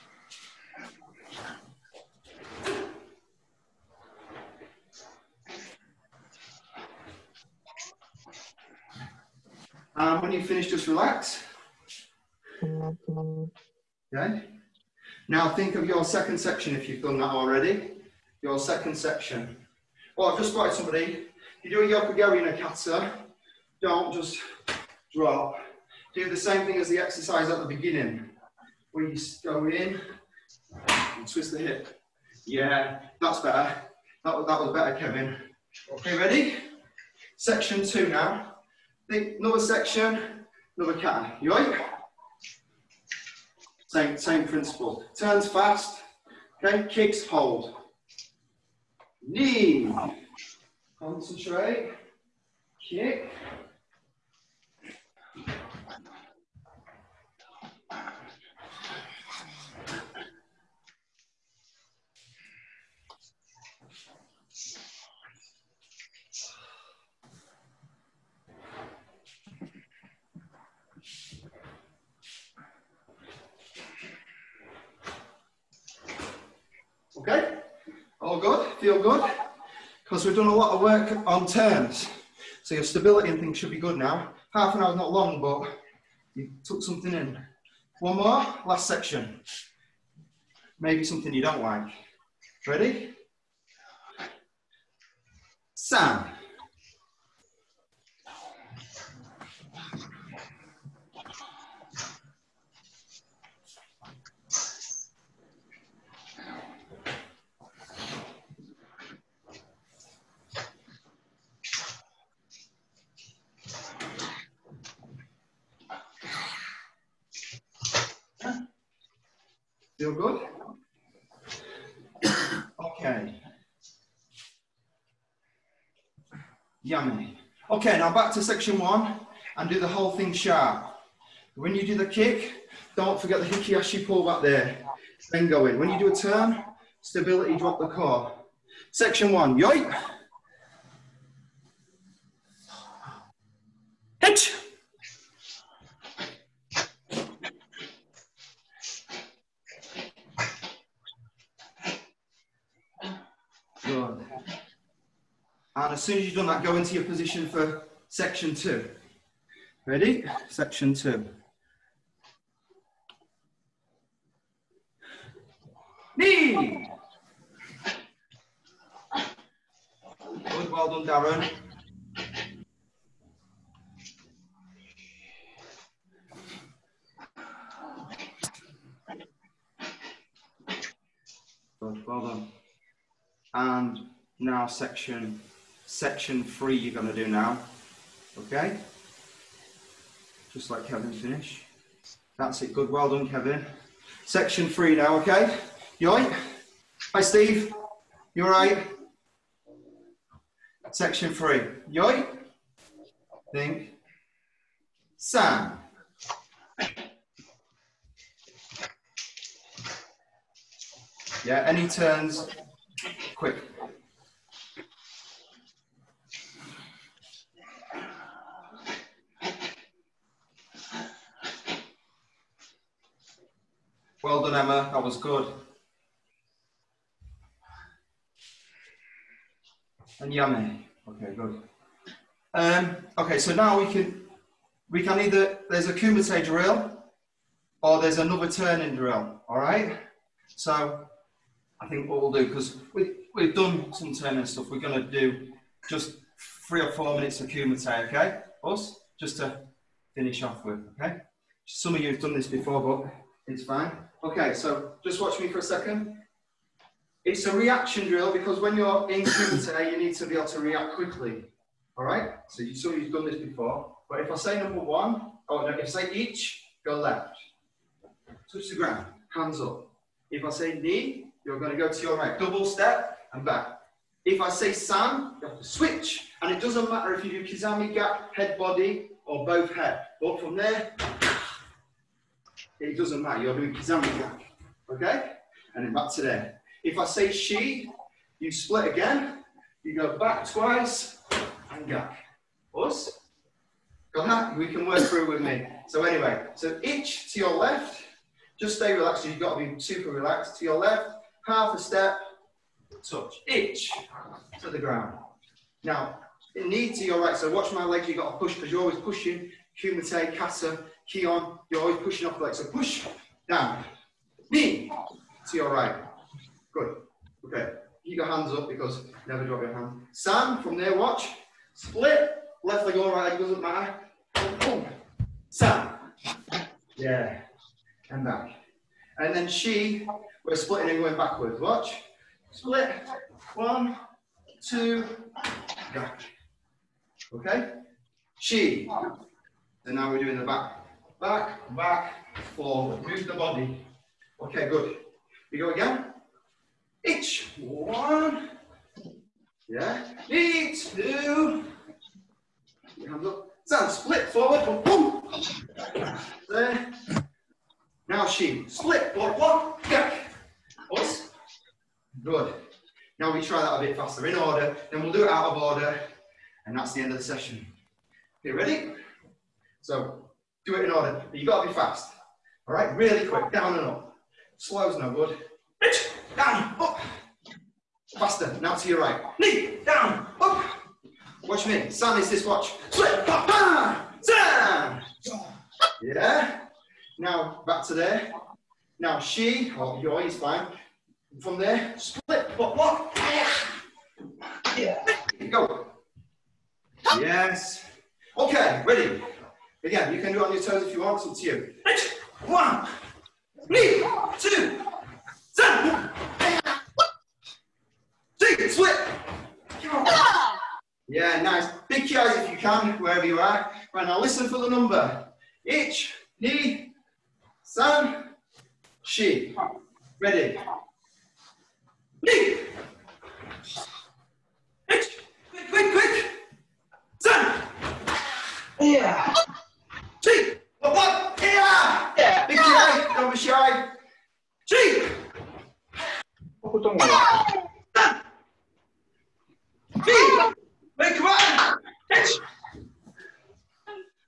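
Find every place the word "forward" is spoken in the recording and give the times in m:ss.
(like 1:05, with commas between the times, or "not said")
5:42, 5:54, 5:59.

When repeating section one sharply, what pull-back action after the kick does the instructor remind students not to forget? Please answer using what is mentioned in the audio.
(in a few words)
hikiashi.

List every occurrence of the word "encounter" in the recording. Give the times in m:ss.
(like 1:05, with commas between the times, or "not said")
not said.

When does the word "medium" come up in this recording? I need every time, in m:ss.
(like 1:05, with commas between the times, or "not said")
not said.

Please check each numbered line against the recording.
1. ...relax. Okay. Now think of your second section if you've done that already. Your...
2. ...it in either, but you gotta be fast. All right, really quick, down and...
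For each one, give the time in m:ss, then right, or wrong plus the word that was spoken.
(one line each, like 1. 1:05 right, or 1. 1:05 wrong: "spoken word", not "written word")
1. 0:10 right
2. 6:10 wrong: "order", not "either".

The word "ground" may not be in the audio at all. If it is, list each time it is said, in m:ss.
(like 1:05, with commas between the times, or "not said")
4:28, 5:04.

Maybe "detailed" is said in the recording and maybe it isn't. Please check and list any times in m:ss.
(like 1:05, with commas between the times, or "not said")
not said.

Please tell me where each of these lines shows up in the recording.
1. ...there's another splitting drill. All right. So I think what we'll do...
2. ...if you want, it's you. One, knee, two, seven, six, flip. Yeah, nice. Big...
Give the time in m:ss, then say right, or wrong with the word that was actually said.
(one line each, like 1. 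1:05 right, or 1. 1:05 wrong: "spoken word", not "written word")
1. 3:58 wrong: "turning", not "splitting"
2. 6:40 right.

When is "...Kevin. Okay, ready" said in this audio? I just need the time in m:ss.
0:34.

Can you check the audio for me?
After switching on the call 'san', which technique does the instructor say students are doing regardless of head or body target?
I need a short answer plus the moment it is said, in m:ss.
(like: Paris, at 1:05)
kizamika, at 4:43.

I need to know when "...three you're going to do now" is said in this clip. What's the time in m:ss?
3:06.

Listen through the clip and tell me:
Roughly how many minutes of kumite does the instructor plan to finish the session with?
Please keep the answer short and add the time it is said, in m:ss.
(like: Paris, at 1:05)
3 or 4 minutes, at 4:06.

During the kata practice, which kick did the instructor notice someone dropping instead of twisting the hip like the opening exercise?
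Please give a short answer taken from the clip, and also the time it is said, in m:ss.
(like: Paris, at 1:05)
Yoko geri, at 0:22.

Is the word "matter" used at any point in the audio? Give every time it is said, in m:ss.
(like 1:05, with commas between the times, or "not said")
4:36, 4:43, 5:23.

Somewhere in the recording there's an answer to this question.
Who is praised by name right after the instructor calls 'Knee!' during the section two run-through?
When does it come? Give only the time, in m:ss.
2:51.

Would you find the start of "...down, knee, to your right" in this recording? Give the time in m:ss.
5:13.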